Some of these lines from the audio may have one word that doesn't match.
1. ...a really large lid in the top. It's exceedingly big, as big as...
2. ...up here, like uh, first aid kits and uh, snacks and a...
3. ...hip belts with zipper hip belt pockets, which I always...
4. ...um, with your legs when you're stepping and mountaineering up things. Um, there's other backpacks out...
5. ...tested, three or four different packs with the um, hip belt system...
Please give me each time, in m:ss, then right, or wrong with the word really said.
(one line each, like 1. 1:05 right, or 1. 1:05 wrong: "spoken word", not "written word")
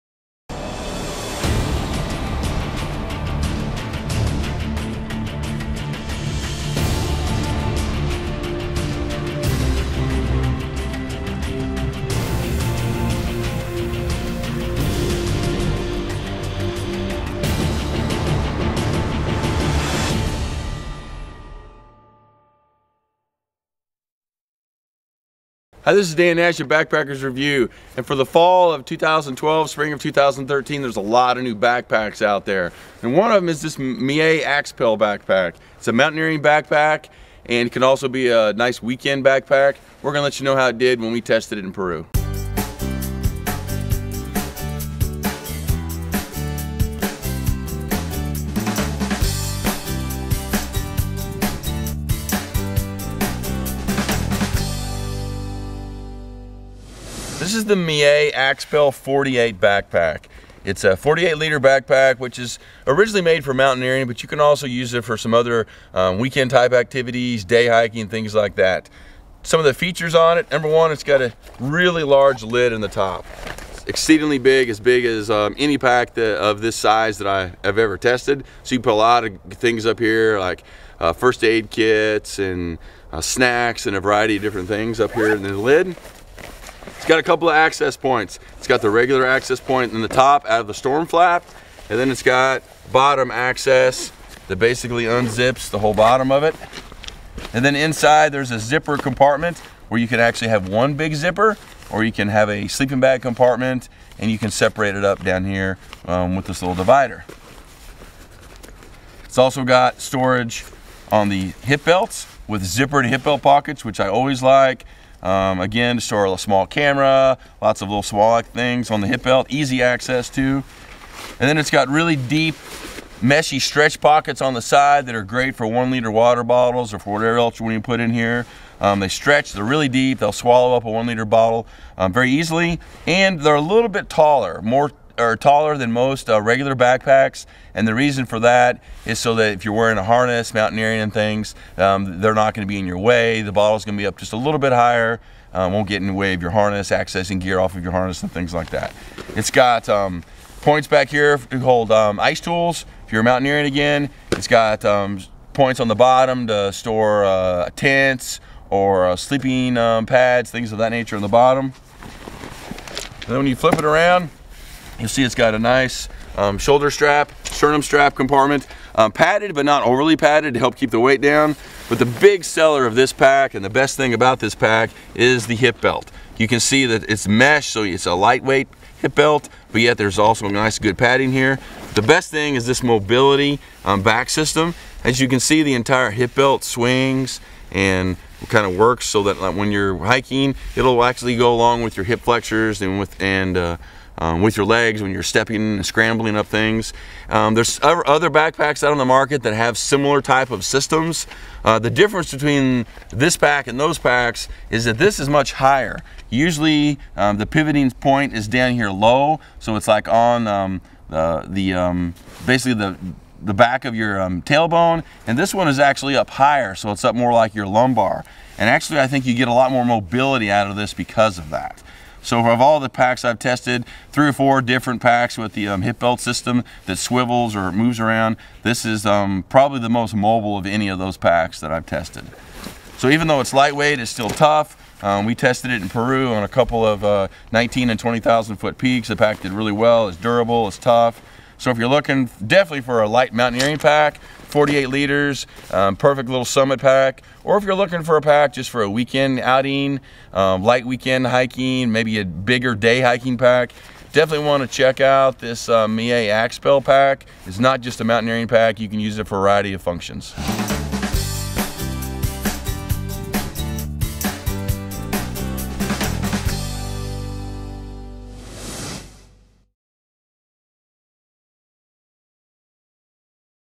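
1. 1:11 right
2. 1:19 right
3. 1:51 right
4. 3:14 wrong: "scrambling", not "mountaineering"
5. 3:43 right.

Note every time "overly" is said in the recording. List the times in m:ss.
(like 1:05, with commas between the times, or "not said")
2:49.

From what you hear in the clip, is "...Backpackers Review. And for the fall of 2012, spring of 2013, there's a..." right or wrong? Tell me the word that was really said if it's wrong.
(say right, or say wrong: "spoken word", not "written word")
right.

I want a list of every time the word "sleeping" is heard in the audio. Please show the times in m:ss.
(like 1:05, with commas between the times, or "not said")
1:42, 2:39.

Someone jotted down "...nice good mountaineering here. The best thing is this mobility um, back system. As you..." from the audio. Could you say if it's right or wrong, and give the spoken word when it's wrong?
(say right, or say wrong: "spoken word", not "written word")
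wrong: "padding", not "mountaineering".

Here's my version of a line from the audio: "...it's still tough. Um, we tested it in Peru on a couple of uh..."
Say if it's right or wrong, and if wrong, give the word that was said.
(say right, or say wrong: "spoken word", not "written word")
right.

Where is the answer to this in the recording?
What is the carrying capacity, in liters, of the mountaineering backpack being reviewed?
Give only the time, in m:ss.
1:00.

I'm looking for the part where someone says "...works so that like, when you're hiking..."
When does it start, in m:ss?
3:08.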